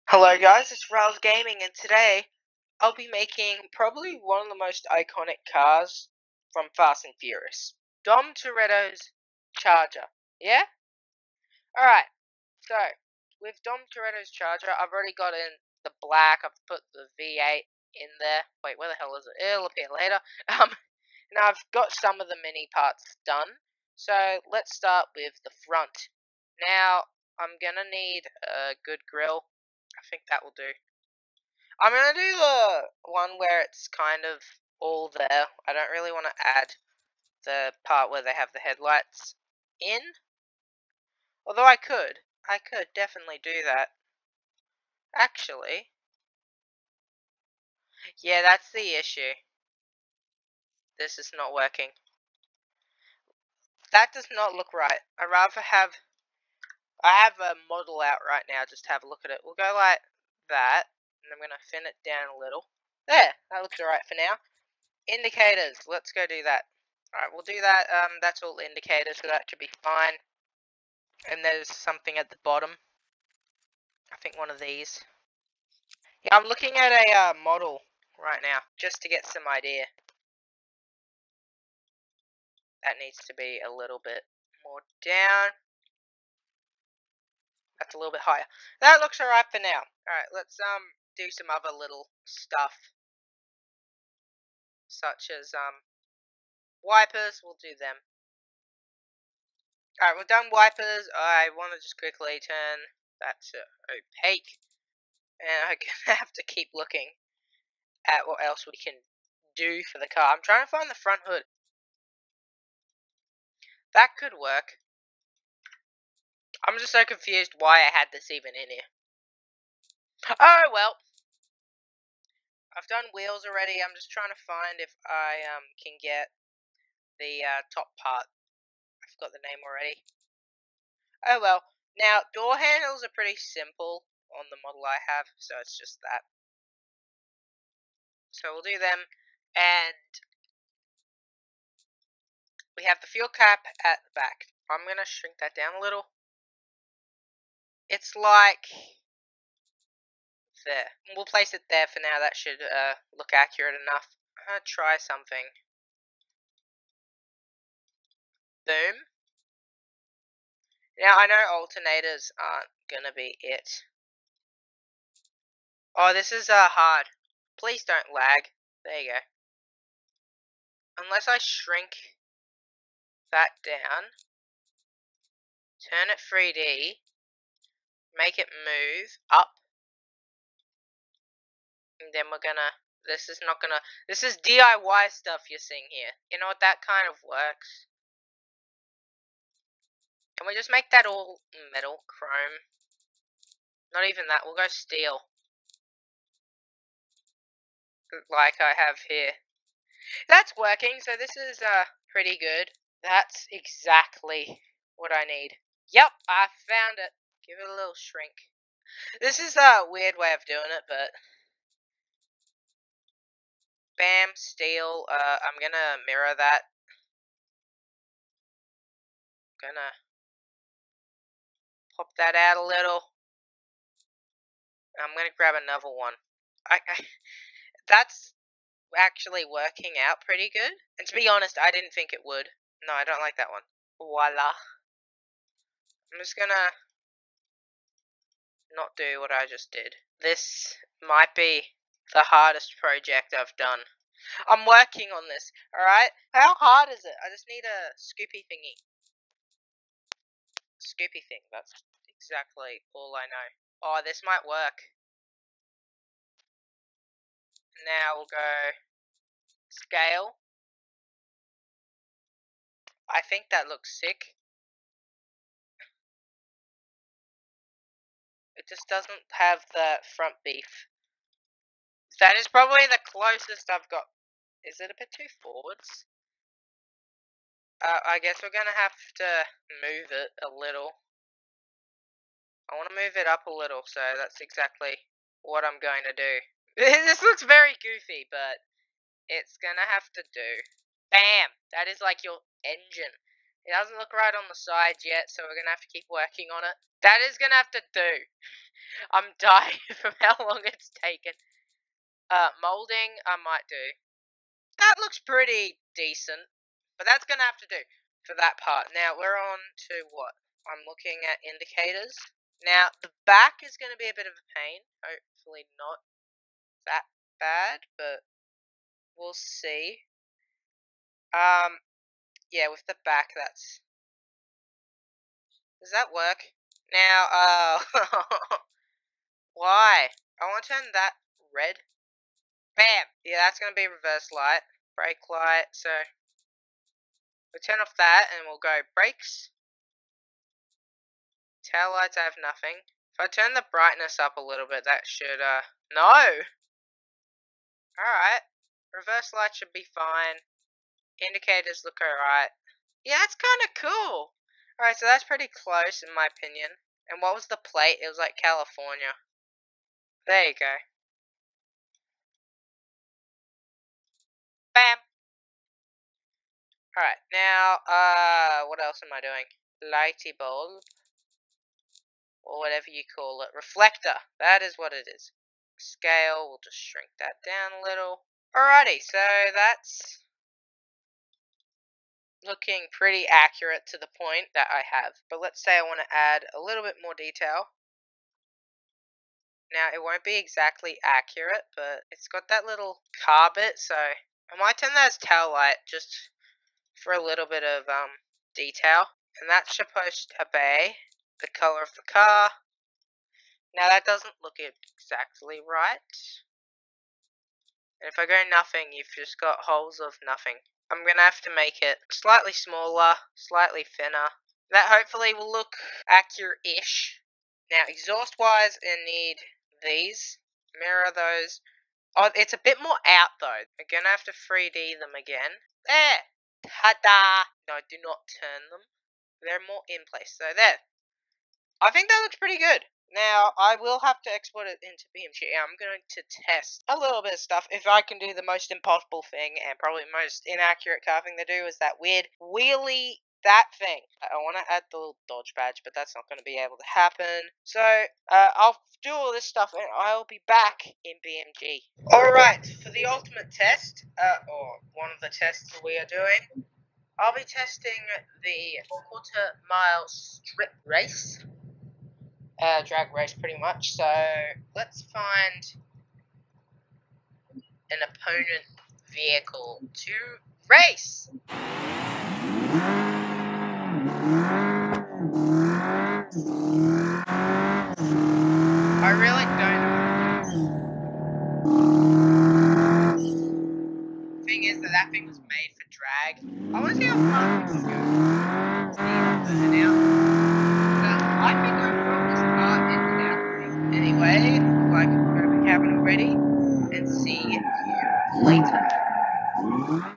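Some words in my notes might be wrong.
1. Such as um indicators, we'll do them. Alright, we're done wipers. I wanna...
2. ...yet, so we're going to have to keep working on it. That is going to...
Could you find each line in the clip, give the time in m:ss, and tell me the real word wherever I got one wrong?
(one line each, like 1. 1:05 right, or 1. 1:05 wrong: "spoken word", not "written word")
1. 1:34 wrong: "wipers", not "indicators"
2. 4:55 right.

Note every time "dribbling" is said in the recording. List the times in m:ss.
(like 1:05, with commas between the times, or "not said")
not said.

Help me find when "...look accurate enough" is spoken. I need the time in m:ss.
2:33.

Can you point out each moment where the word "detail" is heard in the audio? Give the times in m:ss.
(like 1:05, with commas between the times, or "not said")
6:27, 6:38.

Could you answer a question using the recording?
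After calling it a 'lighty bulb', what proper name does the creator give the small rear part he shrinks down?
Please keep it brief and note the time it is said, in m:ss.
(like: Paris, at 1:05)
Reflector, at 6:13.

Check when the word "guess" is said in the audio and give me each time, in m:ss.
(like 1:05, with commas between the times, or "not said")
4:38.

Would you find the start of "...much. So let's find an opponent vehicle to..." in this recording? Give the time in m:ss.
7:43.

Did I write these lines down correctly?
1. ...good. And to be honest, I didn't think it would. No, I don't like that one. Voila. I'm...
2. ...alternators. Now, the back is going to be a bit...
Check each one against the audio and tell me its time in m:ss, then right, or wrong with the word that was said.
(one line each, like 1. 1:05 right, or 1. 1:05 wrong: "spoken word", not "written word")
1. 3:50 right
2. 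5:11 wrong: "indicators", not "alternators".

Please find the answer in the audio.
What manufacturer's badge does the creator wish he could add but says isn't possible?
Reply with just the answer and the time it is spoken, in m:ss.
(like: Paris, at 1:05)
Dodge, at 7:25.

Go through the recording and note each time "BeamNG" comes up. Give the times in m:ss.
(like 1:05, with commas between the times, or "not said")
7:15, 7:31.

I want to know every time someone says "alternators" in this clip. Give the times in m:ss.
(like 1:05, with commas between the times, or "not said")
2:41.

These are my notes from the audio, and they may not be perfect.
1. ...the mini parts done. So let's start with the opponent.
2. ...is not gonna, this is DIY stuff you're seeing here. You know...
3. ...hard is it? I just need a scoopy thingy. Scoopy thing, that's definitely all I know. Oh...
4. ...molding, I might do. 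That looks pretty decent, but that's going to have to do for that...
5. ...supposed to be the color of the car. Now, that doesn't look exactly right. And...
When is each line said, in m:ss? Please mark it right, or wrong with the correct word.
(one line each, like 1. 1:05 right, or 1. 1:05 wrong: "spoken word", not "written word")
1. 0:22 wrong: "front", not "opponent"
2. 3:03 right
3. 4:06 wrong: "exactly", not "definitely"
4. 5:02 right
5. 6:39 right.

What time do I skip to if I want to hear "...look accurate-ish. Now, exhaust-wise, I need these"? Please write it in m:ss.
6:55.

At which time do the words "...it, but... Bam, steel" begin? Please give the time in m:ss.
3:30.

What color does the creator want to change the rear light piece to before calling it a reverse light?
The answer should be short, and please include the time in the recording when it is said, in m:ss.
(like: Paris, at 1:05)
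Red, at 5:31.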